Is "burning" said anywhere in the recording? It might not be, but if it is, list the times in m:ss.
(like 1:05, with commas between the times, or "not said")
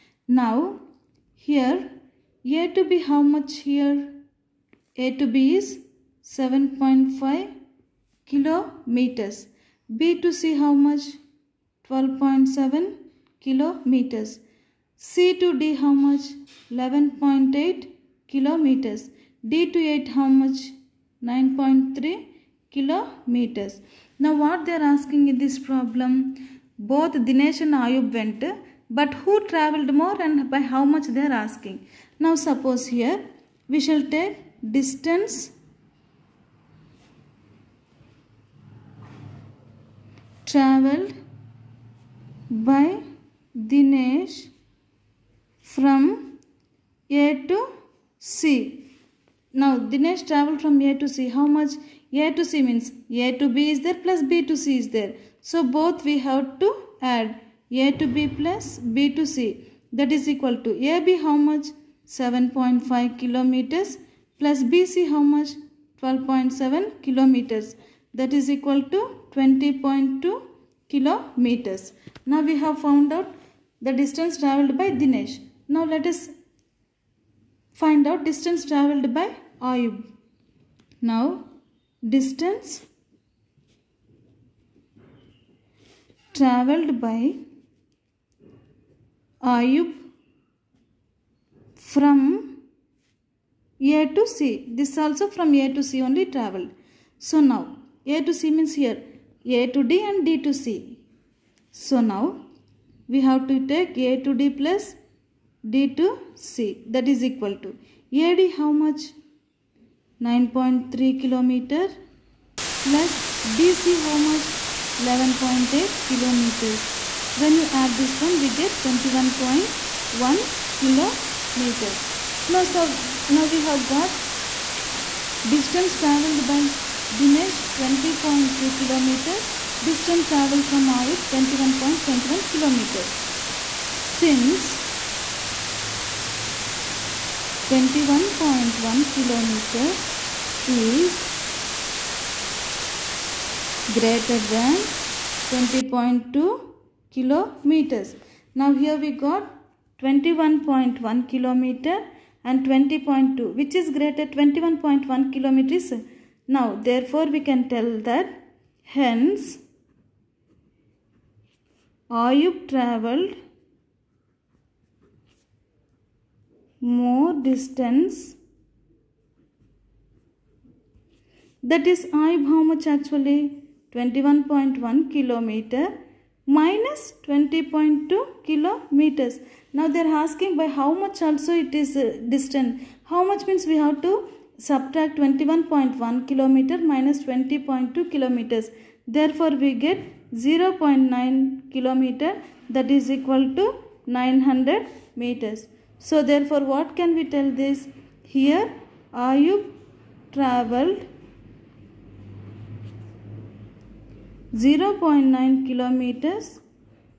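not said.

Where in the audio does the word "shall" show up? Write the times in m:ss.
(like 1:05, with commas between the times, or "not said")
0:33.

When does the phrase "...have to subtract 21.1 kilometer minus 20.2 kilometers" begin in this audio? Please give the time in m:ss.
3:03.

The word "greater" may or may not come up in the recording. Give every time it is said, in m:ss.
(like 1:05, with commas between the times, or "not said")
2:23, 2:33.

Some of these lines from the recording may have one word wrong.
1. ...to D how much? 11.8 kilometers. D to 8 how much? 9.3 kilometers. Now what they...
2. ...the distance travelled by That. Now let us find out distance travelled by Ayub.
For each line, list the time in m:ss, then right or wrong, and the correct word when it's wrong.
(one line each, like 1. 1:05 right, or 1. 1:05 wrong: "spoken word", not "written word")
1. 0:15 right
2. 1:13 wrong: "Dinesh", not "That".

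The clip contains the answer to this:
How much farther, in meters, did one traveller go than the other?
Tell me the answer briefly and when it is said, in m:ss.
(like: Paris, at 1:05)
900 meters, at 3:14.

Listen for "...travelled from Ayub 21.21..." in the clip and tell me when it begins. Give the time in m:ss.
2:10.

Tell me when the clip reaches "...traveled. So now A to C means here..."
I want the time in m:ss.
1:36.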